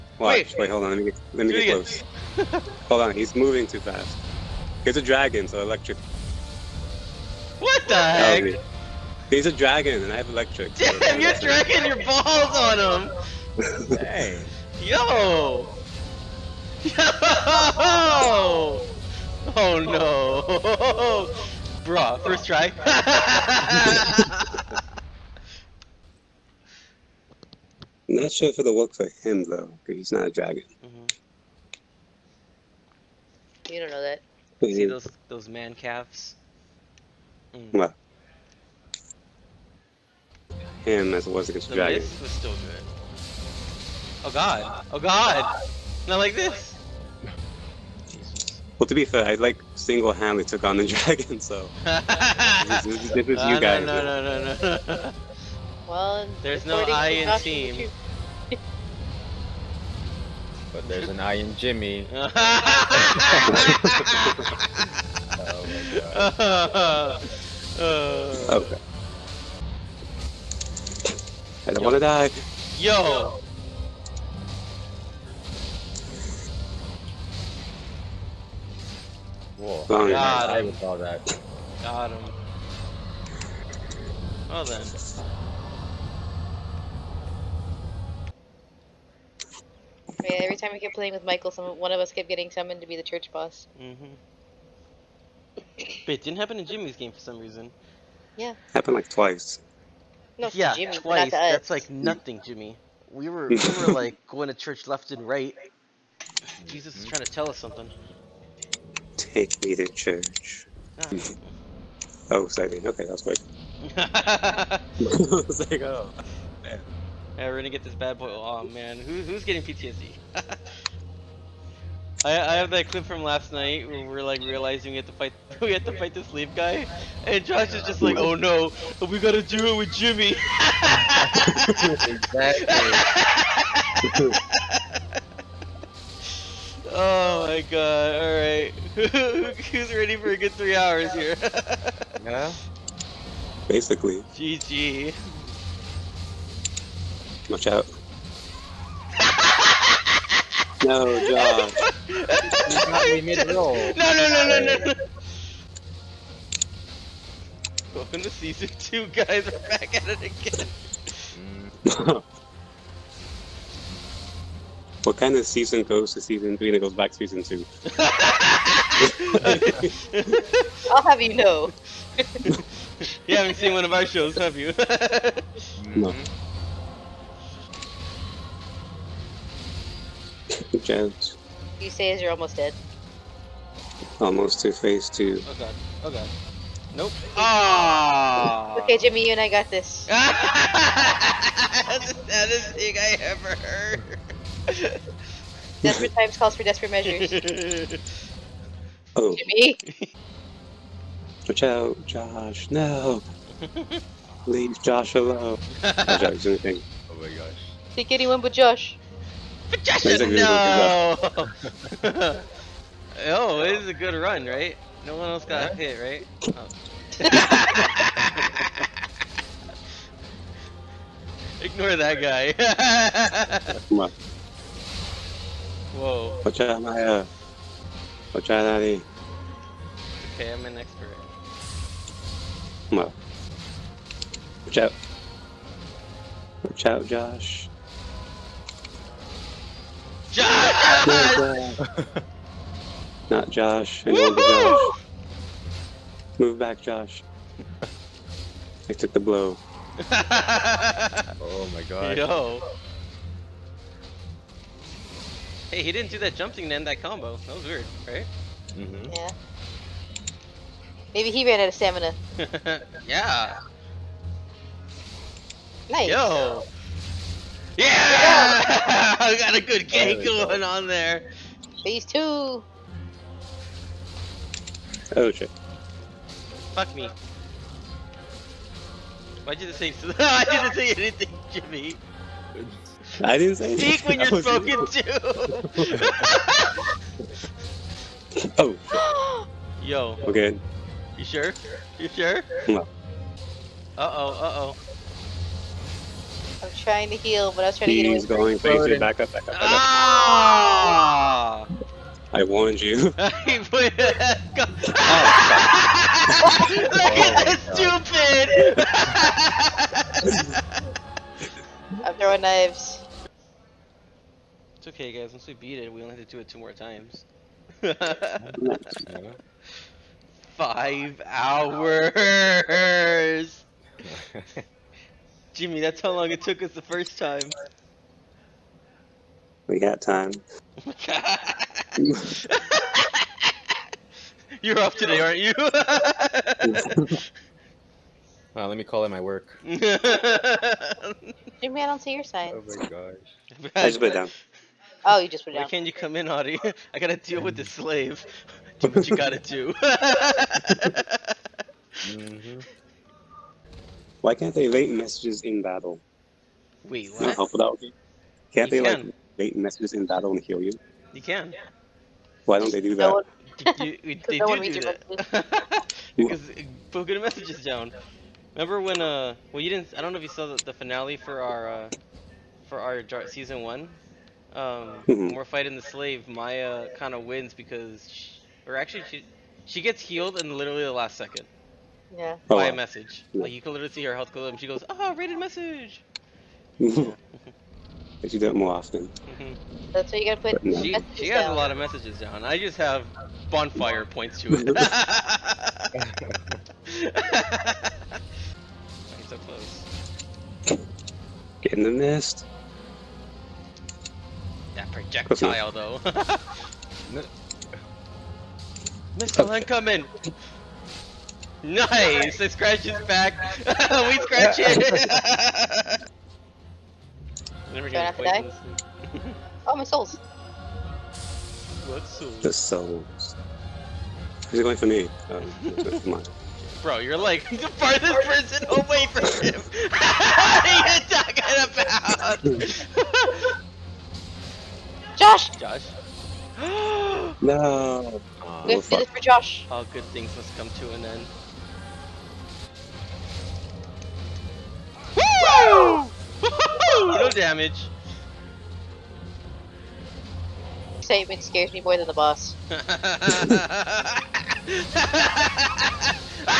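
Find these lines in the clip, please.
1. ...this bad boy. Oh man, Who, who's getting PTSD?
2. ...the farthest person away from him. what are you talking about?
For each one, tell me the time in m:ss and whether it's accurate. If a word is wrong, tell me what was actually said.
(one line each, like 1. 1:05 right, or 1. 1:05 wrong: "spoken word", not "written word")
1. 1:57 right
2. 7:07 right.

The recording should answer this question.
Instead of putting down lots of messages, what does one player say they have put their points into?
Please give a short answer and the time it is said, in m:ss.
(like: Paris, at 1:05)
Bonfire, at 6:33.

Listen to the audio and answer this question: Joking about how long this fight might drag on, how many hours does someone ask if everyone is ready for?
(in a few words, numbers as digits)
3 hours.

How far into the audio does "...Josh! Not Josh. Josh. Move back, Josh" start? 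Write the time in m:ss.
4:01.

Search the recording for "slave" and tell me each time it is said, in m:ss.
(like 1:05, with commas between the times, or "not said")
5:47, 6:15.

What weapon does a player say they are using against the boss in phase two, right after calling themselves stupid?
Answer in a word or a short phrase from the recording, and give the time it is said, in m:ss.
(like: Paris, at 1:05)
Knives, at 5:12.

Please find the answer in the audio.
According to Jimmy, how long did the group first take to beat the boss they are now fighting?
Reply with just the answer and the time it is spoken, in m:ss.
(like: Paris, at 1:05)
5 hours, at 5:20.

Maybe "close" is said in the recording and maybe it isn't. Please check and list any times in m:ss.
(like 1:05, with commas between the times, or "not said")
0:01, 6:39.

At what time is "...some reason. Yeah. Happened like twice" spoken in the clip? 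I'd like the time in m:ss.
1:37.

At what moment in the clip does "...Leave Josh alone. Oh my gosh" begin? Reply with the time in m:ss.
3:24.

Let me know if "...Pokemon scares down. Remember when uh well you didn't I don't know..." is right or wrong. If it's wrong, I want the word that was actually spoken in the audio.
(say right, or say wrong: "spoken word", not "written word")
wrong: "messages", not "scares".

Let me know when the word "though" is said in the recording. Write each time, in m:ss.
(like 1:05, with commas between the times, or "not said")
0:29, 6:45.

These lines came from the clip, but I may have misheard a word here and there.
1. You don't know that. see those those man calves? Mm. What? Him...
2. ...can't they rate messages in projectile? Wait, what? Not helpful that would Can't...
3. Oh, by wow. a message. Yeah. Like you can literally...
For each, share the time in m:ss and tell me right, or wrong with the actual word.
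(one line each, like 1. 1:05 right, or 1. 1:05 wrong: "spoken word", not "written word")
1. 0:33 right
2. 5:54 wrong: "battle", not "projectile"
3. 6:22 right.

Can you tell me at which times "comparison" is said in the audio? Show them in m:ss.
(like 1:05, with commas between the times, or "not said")
not said.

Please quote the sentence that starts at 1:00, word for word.
but there's an I in Jimmy.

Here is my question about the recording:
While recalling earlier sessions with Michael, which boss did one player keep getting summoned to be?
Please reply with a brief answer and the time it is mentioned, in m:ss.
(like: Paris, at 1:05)
Church boss, at 1:33.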